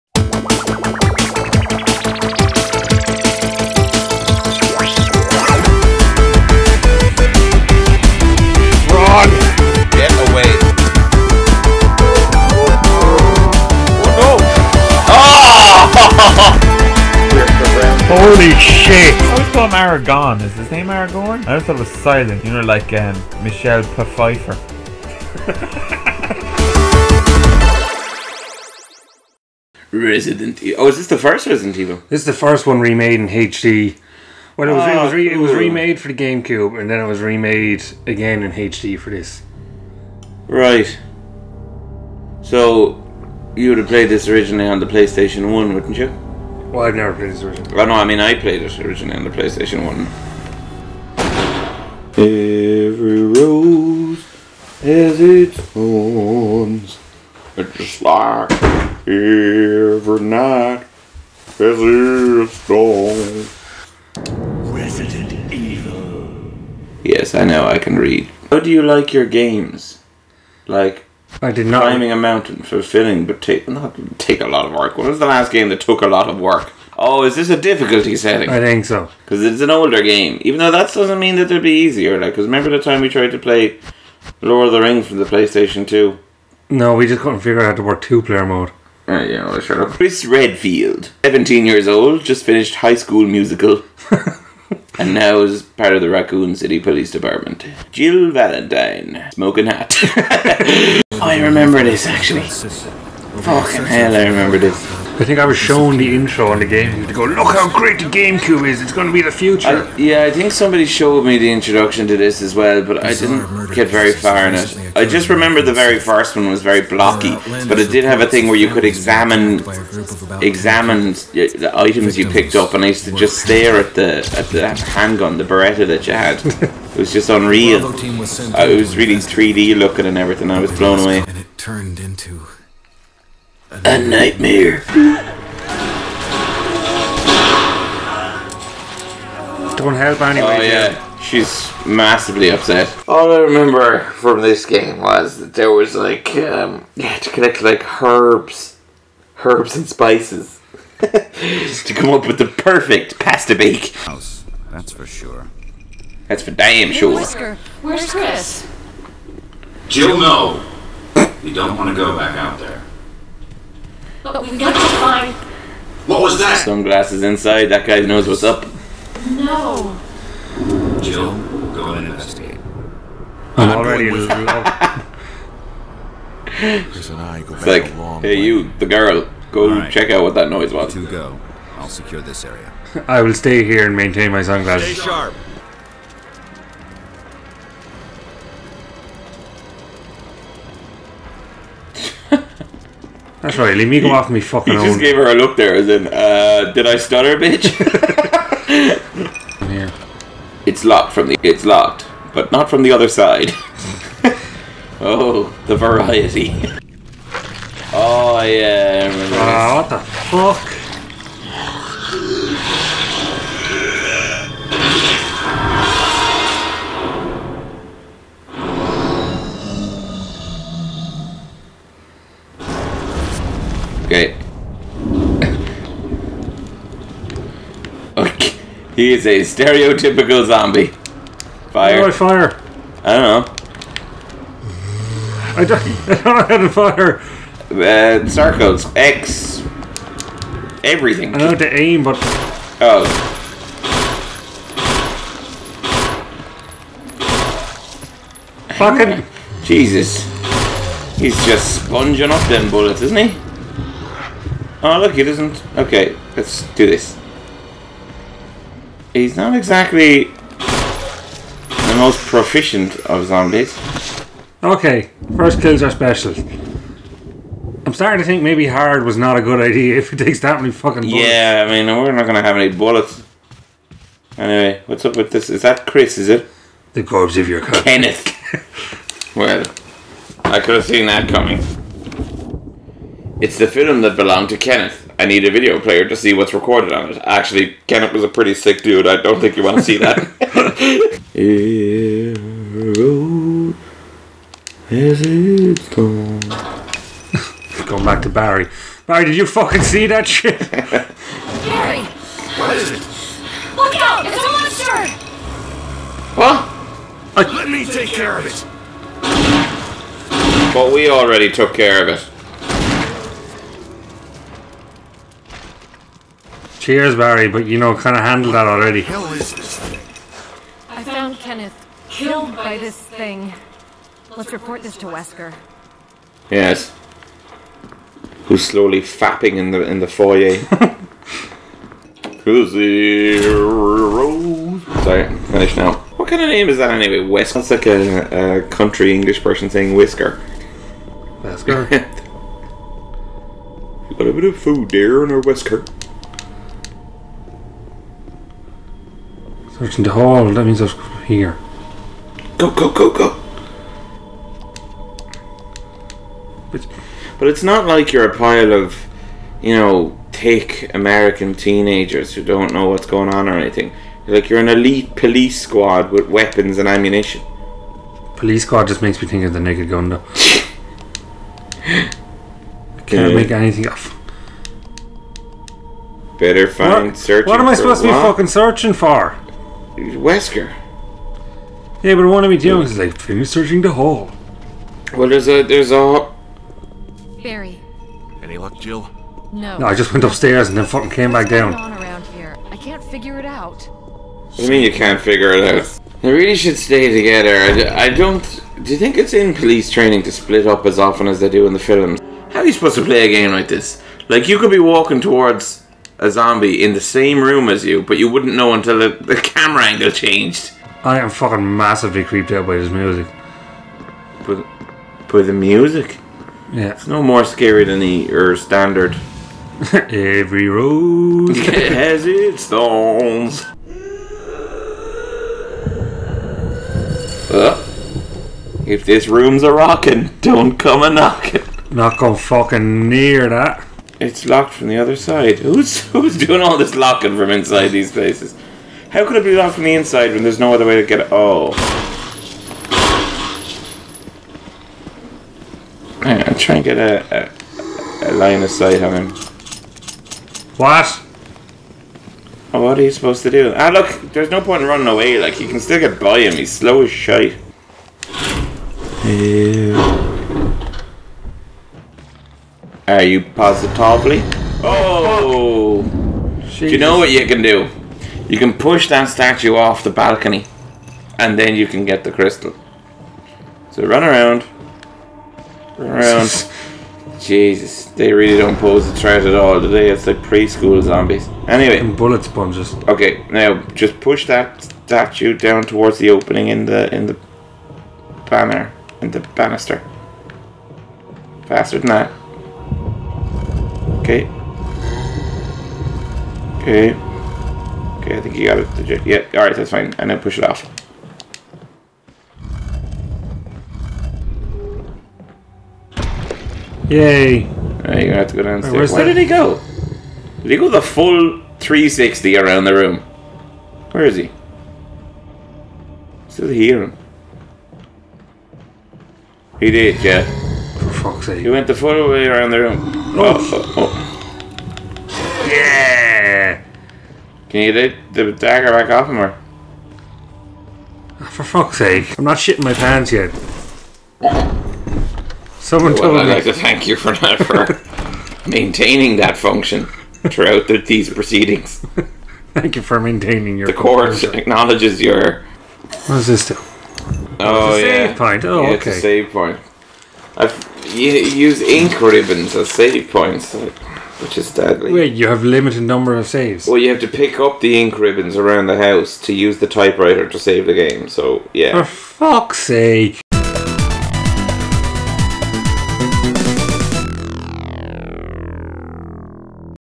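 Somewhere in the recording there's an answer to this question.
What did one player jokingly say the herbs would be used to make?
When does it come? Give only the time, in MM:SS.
02:33.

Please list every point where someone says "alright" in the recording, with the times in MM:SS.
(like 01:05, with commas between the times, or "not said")
08:19.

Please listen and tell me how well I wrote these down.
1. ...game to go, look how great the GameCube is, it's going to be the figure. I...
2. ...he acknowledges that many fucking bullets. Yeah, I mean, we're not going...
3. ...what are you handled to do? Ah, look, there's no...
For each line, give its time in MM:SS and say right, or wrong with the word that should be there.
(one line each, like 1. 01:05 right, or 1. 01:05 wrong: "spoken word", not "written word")
1. 01:46 wrong: "future", not "figure"
2. 04:30 wrong: "takes", not "acknowledges"
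3. 07:32 wrong: "supposed", not "handled".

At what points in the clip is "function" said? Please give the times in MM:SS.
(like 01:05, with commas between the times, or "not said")
08:59, 09:04.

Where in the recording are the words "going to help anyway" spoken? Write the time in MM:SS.
02:19.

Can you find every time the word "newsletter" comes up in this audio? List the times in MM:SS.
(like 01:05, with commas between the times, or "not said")
not said.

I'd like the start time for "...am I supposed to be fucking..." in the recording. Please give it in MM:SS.
06:17.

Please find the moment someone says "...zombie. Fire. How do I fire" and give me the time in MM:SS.
03:50.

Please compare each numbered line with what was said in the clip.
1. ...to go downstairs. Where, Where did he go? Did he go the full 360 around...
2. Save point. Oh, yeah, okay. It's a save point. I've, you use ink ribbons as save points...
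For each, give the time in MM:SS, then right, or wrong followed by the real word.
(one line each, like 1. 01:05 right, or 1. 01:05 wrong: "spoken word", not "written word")
1. 08:28 right
2. 09:08 right.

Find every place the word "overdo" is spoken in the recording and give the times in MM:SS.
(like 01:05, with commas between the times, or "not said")
not said.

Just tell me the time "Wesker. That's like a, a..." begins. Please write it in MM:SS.
05:37.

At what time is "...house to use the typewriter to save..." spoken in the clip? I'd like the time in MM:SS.
09:18.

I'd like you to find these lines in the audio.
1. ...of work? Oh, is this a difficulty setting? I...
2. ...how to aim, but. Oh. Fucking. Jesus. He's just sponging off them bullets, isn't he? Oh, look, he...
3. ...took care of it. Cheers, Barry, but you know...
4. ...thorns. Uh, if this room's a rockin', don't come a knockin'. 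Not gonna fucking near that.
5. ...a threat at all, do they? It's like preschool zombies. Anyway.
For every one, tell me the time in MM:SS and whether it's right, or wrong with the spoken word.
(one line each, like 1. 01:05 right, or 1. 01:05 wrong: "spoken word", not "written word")
1. 01:16 right
2. 04:01 right
3. 05:11 right
4. 07:02 right
5. 07:59 right.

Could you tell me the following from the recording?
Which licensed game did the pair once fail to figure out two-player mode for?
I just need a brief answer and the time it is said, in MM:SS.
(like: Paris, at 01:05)
Lord of the Rings, at 01:24.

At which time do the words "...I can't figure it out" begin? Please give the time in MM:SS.
06:32.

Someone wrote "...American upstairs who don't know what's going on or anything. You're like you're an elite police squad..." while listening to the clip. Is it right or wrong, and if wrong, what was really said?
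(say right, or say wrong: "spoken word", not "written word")
wrong: "teenagers", not "upstairs".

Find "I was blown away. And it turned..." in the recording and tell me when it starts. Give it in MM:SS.
02:10.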